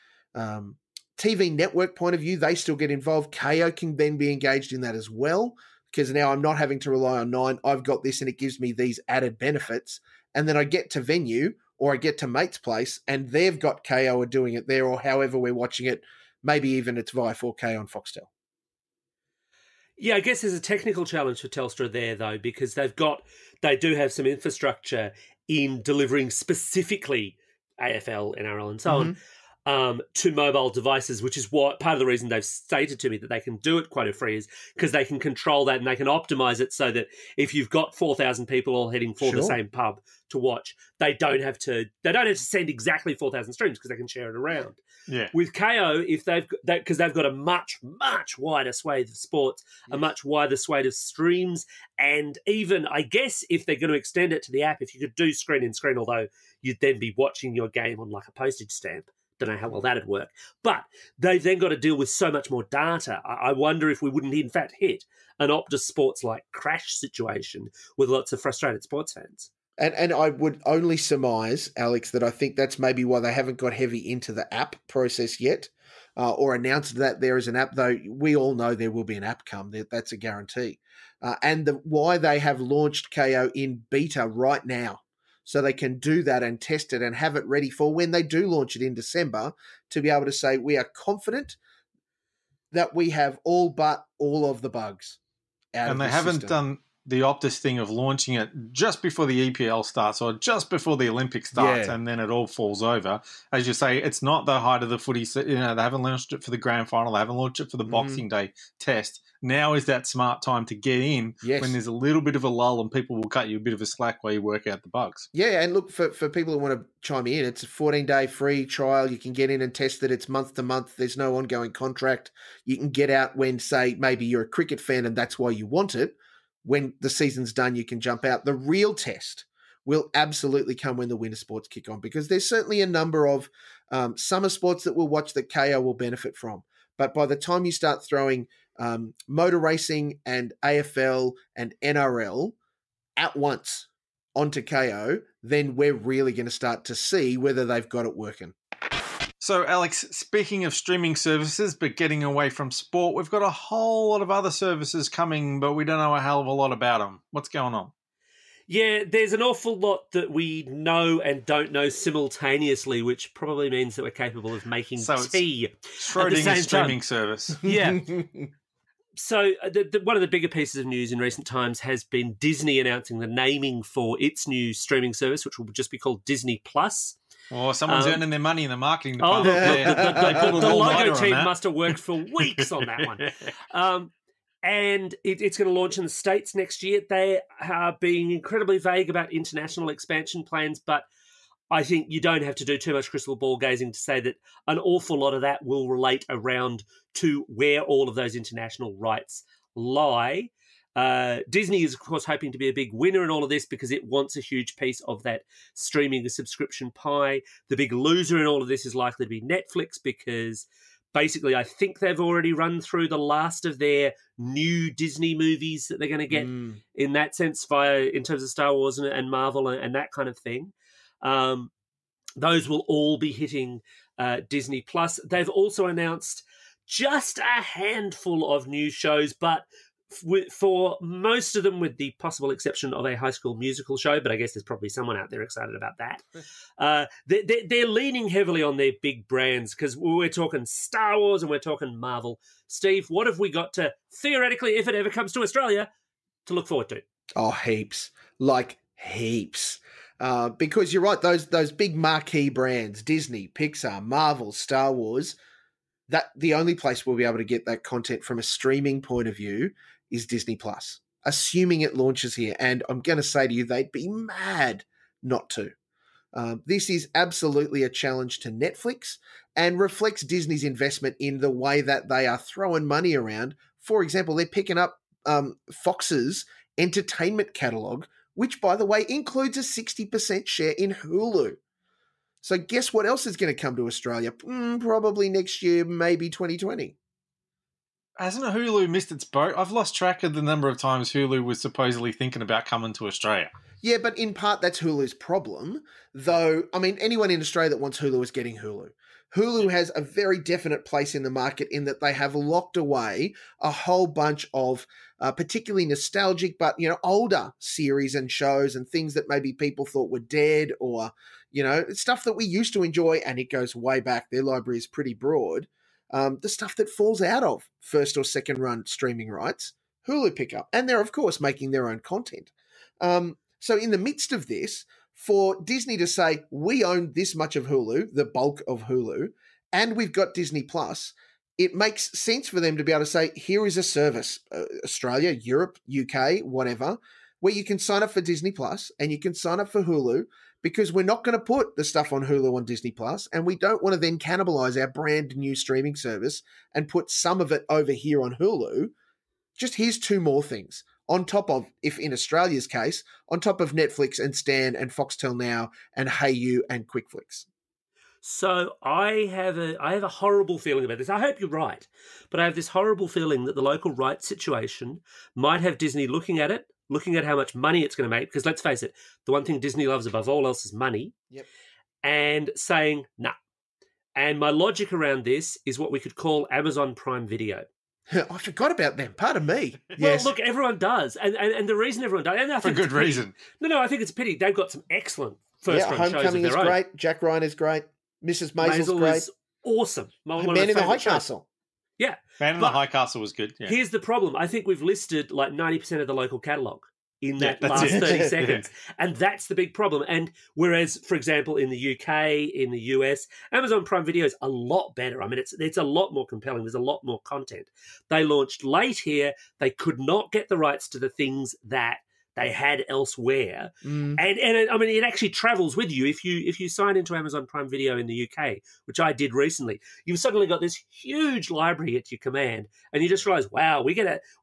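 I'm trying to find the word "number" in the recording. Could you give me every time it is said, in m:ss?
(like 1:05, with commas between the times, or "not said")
2:12, 4:50.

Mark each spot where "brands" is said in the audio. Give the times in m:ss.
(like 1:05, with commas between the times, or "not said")
3:59, 4:12, 5:44.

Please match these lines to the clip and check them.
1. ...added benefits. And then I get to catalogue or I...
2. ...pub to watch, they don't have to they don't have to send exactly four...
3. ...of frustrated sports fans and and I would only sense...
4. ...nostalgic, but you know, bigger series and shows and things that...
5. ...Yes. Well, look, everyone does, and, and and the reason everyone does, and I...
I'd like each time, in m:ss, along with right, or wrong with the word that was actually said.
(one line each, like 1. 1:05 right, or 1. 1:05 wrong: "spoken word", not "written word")
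1. 0:09 wrong: "venue", not "catalogue"
2. 0:39 right
3. 1:08 wrong: "surmise", not "sense"
4. 5:05 wrong: "older", not "bigger"
5. 6:19 right.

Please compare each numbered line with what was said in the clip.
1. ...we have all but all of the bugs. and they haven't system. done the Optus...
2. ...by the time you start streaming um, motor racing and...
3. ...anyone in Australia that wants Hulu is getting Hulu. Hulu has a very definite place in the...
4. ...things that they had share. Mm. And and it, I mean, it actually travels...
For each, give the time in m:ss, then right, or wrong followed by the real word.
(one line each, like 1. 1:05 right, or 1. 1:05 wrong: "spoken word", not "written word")
1. 1:32 right
2. 2:17 wrong: "throwing", not "streaming"
3. 4:57 right
4. 6:51 wrong: "elsewhere", not "share".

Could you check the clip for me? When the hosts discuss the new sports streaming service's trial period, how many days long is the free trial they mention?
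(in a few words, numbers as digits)
14.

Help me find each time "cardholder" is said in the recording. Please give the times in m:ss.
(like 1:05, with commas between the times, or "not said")
not said.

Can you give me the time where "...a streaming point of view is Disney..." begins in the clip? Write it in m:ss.
4:18.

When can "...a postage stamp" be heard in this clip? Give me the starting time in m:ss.
0:58.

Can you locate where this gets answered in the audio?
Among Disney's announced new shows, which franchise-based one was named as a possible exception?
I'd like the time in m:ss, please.
3:53.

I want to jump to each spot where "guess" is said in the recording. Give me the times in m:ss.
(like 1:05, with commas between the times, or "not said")
0:20, 0:53, 3:54, 4:42.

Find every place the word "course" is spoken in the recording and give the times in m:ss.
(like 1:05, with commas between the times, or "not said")
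3:22, 5:21.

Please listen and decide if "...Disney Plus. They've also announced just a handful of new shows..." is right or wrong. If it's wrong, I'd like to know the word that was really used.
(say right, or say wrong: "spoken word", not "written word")
right.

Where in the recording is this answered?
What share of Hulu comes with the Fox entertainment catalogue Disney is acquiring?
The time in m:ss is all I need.
4:39.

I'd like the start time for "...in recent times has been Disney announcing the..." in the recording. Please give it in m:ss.
2:51.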